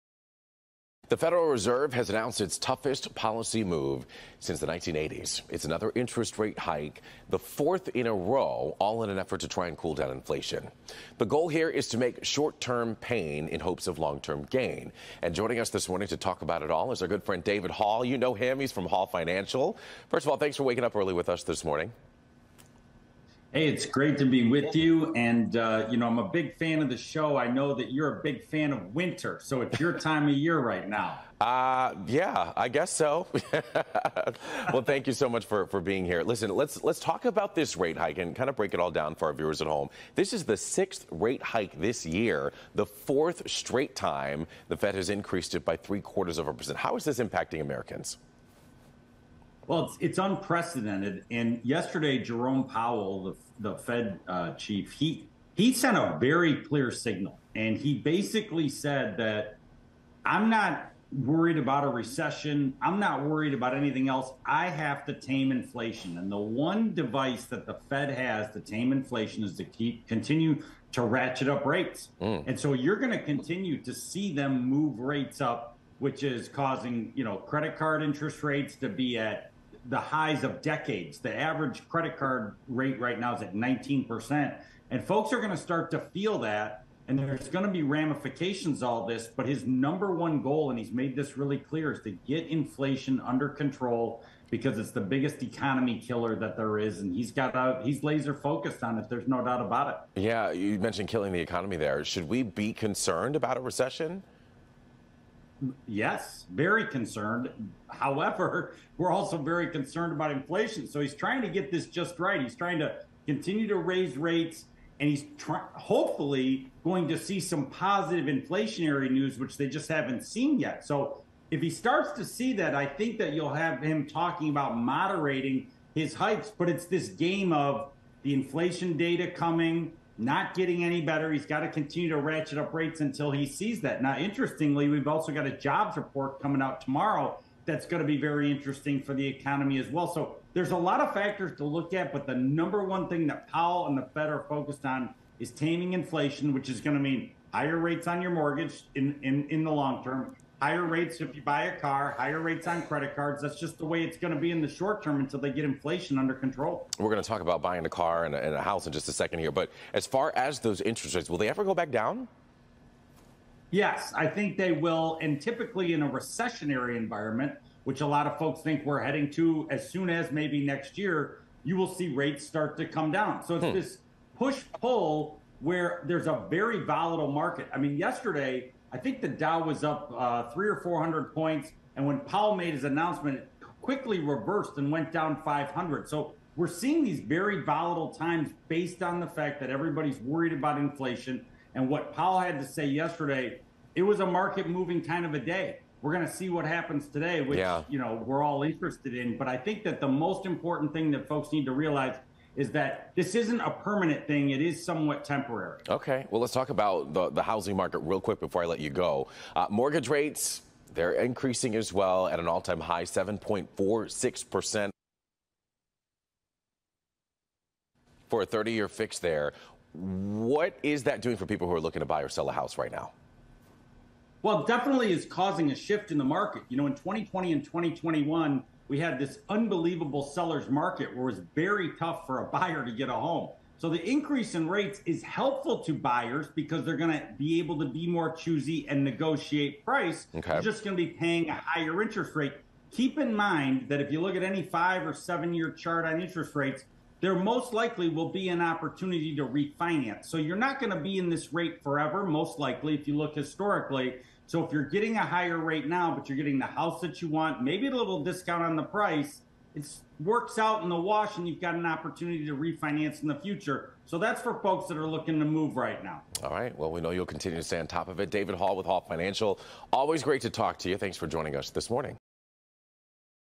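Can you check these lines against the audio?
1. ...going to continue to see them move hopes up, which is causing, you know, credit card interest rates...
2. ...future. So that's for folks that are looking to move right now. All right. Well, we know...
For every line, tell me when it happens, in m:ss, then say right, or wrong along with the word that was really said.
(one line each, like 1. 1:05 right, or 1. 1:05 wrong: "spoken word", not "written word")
1. 1:12 wrong: "rates", not "hopes"
2. 4:23 right.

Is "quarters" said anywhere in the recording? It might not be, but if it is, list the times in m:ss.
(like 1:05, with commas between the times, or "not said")
0:45.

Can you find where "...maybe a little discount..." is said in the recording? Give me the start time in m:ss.
4:17.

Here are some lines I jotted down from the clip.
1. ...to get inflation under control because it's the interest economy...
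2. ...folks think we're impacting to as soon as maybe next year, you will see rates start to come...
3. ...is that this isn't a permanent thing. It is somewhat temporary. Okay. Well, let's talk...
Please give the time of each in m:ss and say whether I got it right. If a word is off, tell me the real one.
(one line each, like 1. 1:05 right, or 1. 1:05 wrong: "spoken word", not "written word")
1. 1:32 wrong: "biggest", not "interest"
2. 2:48 wrong: "heading", not "impacting"
3. 3:22 right.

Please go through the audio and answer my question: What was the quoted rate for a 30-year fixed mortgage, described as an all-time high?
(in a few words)
7.46%.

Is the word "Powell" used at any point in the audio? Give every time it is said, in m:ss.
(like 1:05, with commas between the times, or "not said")
0:52, 2:23, 3:02, 3:12.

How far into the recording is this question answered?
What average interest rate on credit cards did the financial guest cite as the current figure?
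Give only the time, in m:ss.
1:23.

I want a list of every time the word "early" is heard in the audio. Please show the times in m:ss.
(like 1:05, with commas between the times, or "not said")
0:20.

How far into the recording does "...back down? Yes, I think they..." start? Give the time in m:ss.
2:41.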